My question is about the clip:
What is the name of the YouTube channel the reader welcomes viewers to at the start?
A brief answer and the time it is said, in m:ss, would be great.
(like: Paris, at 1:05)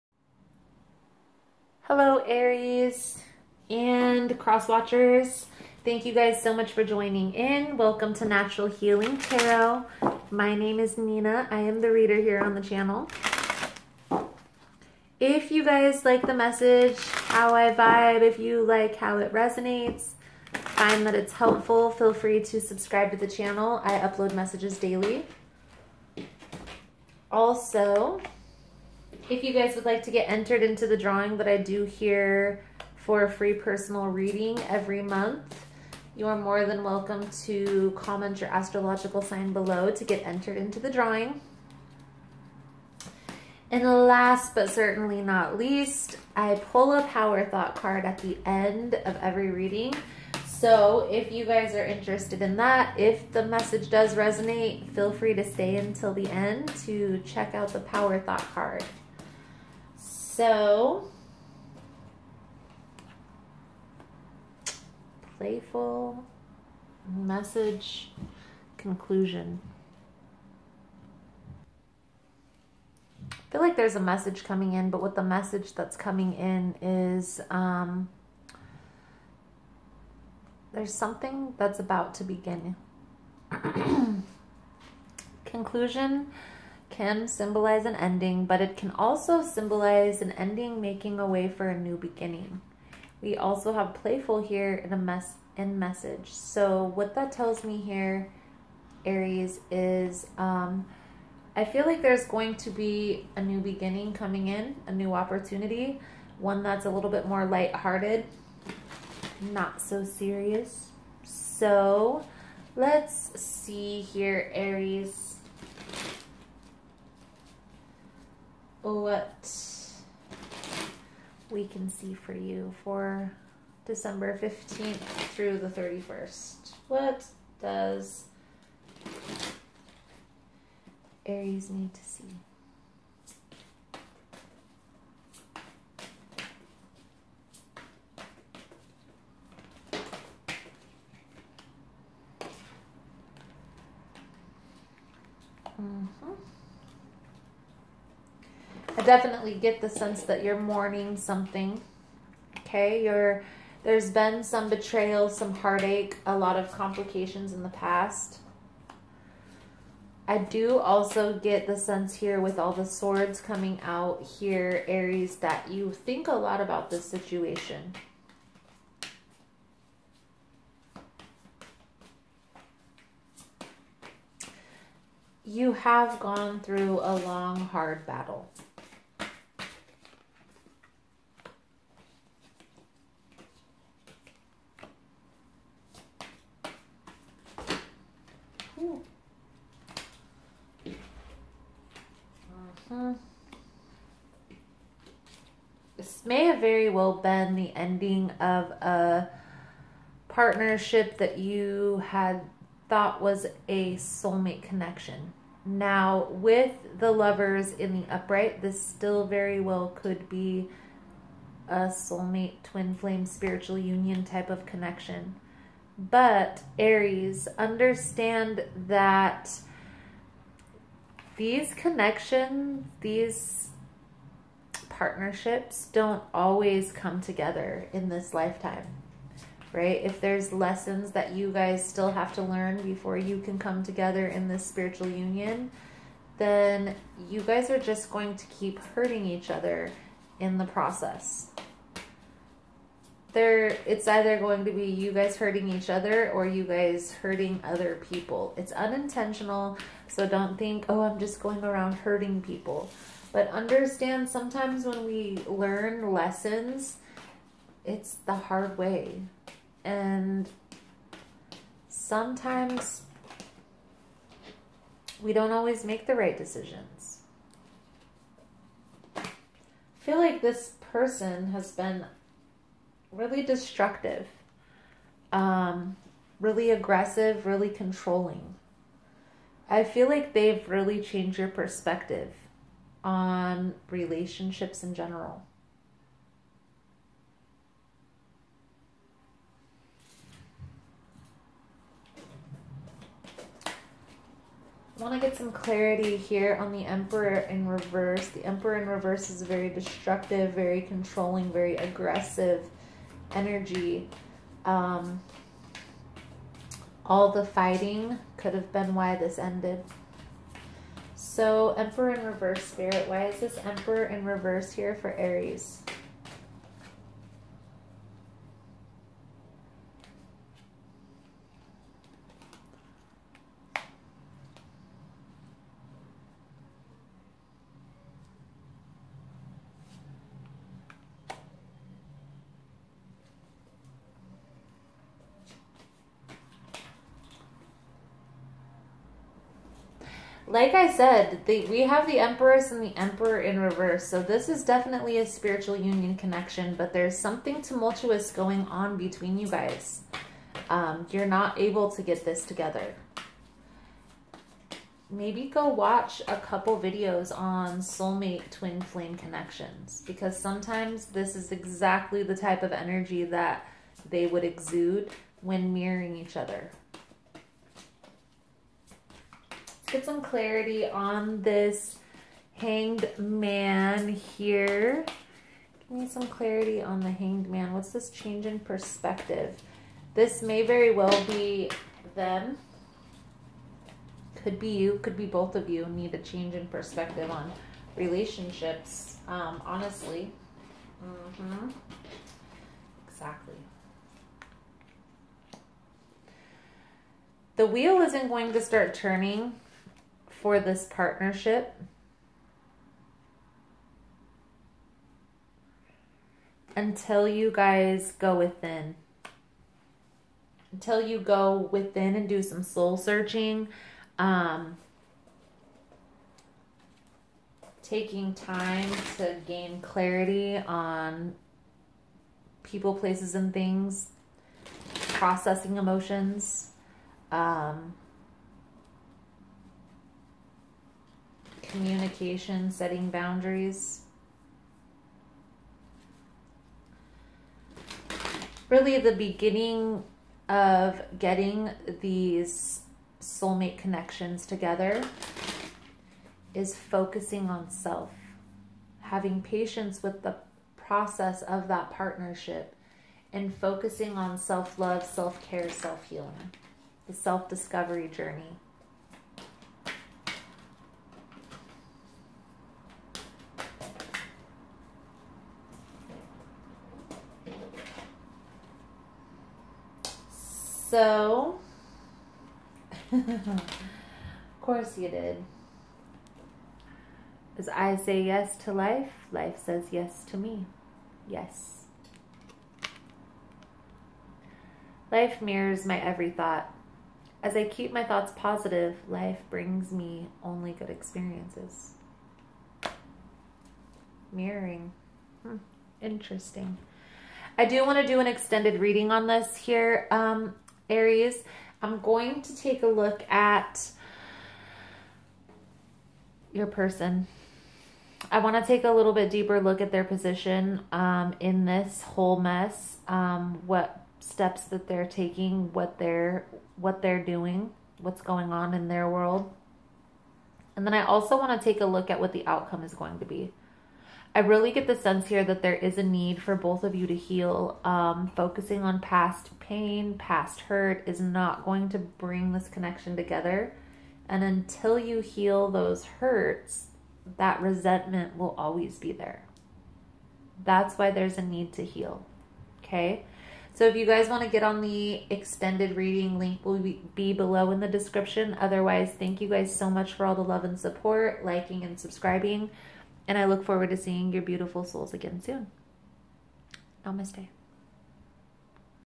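Natural Healing Tarot, at 0:08.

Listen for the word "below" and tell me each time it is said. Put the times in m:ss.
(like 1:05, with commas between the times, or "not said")
0:39, 9:07.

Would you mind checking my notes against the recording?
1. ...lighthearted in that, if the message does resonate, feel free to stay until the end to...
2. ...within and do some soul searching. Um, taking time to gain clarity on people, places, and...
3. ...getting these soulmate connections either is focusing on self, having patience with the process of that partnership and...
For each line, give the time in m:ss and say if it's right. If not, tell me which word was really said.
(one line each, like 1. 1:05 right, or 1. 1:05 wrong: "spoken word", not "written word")
1. 0:51 wrong: "interested", not "lighthearted"
2. 6:51 right
3. 7:21 wrong: "together", not "either".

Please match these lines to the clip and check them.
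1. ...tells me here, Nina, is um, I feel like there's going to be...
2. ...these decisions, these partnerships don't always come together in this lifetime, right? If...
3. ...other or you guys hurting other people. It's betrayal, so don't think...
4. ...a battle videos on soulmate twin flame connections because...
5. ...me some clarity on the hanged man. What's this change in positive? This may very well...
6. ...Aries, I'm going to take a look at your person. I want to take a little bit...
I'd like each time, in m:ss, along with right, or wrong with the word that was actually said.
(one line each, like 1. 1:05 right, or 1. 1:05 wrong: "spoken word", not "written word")
1. 1:37 wrong: "Aries", not "Nina"
2. 3:41 wrong: "connections", not "decisions"
3. 4:05 wrong: "unintentional", not "betrayal"
4. 5:56 wrong: "couple", not "battle"
5. 6:15 wrong: "perspective", not "positive"
6. 8:20 right.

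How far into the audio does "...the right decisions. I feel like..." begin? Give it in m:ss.
4:26.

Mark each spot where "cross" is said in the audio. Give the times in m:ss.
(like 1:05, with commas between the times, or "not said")
0:04.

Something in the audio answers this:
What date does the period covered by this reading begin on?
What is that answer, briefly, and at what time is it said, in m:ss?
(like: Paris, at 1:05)
December 15th, at 2:03.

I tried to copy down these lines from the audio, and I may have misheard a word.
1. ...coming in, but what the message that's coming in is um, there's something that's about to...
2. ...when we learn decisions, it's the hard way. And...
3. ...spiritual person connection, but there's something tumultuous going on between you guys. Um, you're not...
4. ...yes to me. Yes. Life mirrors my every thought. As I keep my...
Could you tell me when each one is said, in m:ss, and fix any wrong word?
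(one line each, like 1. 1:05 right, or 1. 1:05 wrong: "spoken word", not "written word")
1. 1:14 right
2. 4:14 wrong: "lessons", not "decisions"
3. 5:45 wrong: "union", not "person"
4. 7:59 right.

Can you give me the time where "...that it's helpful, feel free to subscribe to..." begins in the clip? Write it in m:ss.
0:21.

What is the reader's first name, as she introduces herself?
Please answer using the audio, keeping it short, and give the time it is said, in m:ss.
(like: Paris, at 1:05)
Nina, at 0:10.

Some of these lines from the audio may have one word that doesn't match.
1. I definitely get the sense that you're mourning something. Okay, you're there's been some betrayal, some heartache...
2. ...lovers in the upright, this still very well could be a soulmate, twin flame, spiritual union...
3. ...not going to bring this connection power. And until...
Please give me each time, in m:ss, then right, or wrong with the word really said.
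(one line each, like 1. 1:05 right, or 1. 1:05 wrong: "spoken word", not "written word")
1. 2:29 right
2. 3:27 right
3. 8:51 wrong: "together", not "power".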